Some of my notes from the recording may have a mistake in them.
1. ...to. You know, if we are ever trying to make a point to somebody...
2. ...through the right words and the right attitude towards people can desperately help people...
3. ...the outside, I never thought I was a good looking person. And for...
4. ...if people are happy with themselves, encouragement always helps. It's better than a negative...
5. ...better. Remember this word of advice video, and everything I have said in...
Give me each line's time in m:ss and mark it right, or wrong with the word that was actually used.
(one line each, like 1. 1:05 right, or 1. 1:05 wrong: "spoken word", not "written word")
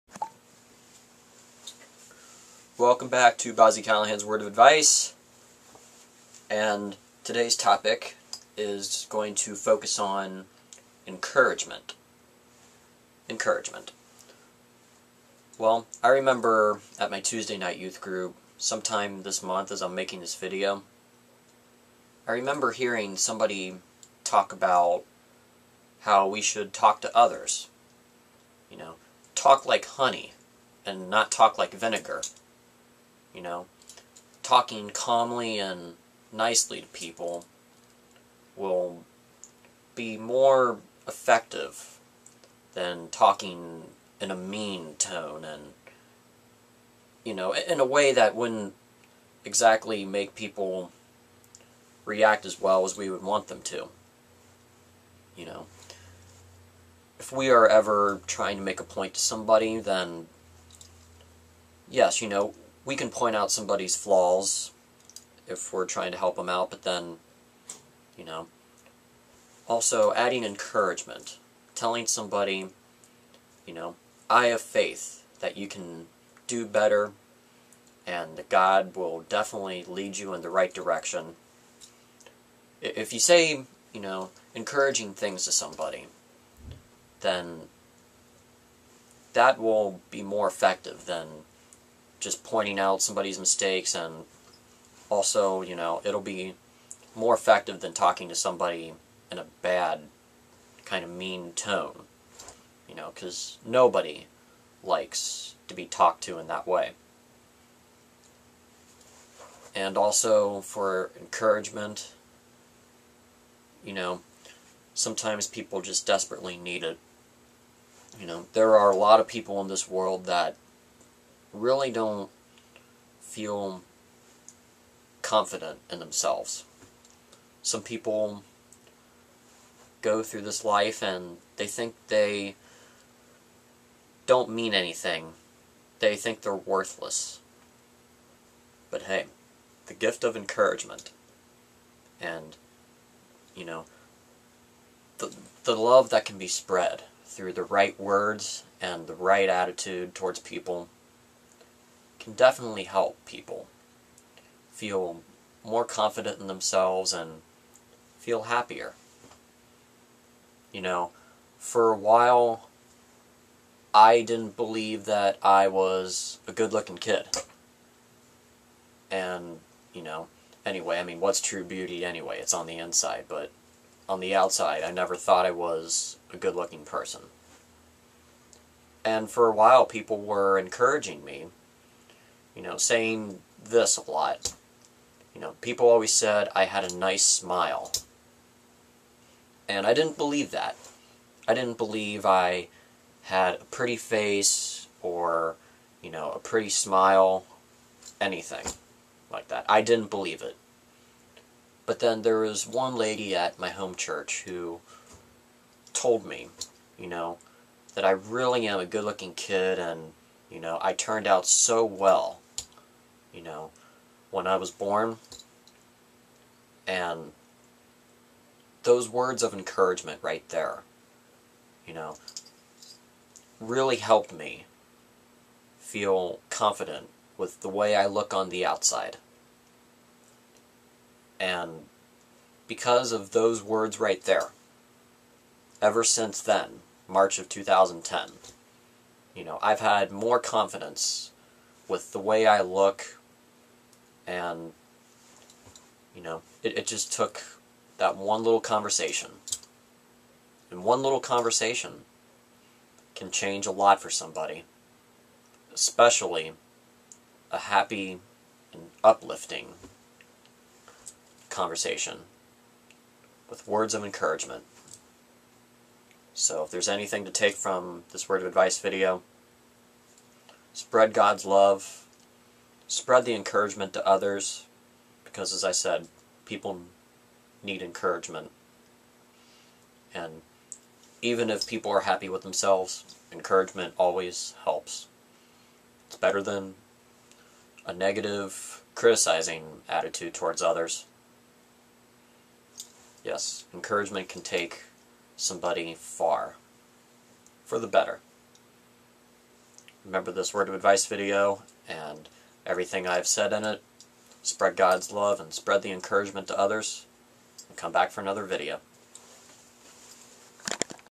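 1. 0:53 right
2. 2:27 wrong: "definitely", not "desperately"
3. 2:54 right
4. 4:41 right
5. 4:57 right.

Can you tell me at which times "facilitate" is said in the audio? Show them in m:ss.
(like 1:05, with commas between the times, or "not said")
not said.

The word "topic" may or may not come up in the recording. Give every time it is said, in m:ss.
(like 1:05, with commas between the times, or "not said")
0:07.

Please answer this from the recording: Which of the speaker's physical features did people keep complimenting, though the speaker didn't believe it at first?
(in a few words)
a nice smile.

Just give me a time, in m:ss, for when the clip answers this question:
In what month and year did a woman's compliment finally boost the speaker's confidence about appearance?
3:57.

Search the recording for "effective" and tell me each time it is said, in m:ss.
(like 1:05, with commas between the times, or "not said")
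0:41, 1:30, 1:37.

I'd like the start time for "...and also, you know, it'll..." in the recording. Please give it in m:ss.
1:33.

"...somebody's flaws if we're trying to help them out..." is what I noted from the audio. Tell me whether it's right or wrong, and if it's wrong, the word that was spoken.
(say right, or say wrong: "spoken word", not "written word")
right.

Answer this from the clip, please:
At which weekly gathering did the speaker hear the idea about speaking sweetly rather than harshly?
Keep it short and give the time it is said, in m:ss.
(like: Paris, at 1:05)
Tuesday night youth group, at 0:17.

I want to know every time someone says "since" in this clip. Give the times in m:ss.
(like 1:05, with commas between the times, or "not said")
3:56.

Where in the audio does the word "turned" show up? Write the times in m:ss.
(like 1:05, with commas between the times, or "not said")
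3:30.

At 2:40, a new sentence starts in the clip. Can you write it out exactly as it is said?
You know, for a while, I didn't believe that I was a good looking kid.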